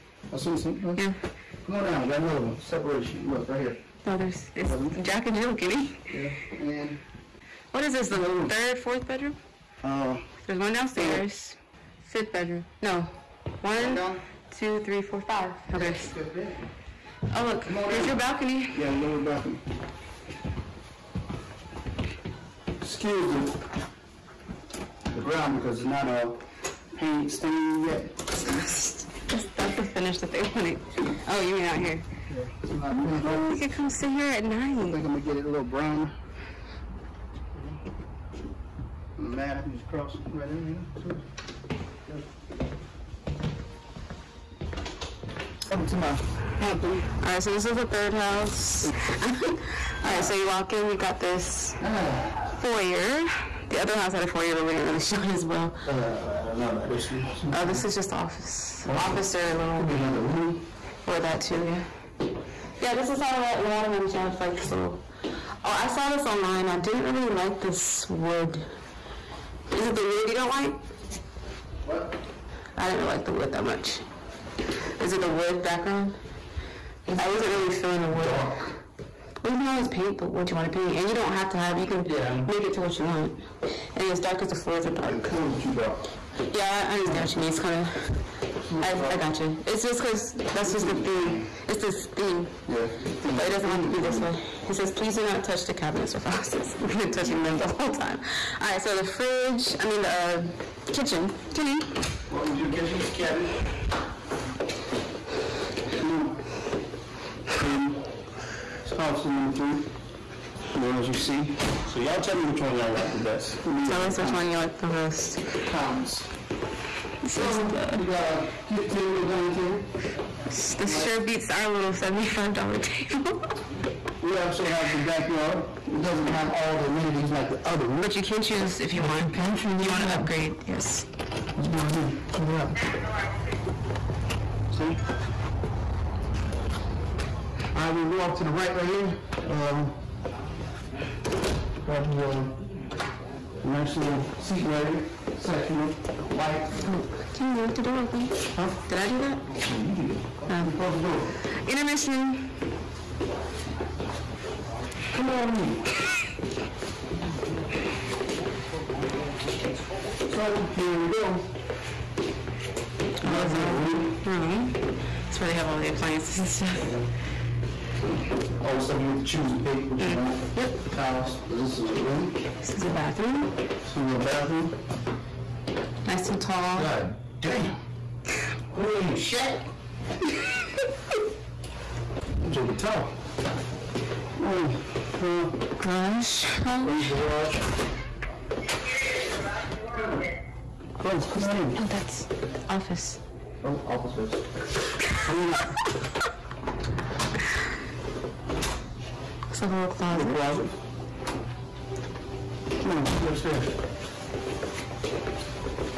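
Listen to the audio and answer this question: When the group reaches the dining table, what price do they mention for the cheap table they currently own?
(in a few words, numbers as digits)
$75.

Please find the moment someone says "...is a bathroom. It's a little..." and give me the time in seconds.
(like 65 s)
172 s.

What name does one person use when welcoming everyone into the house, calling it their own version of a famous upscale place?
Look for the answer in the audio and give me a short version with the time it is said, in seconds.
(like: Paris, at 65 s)
Hampton, at 46 s.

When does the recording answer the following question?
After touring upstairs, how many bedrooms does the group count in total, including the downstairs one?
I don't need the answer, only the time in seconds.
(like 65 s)
12 s.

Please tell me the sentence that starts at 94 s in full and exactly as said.
It says, please do not touch the cabinets or faucets.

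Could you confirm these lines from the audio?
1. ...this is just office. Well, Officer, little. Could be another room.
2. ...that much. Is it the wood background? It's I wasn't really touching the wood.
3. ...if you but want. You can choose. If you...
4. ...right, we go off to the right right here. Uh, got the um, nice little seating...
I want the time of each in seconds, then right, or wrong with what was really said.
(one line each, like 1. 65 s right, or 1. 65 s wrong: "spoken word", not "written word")
1. 57 s right
2. 73 s wrong: "feeling", not "touching"
3. 128 s right
4. 137 s right.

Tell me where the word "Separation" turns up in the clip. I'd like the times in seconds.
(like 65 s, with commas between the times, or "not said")
2 s.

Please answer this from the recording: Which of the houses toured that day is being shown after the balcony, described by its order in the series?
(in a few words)
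third house.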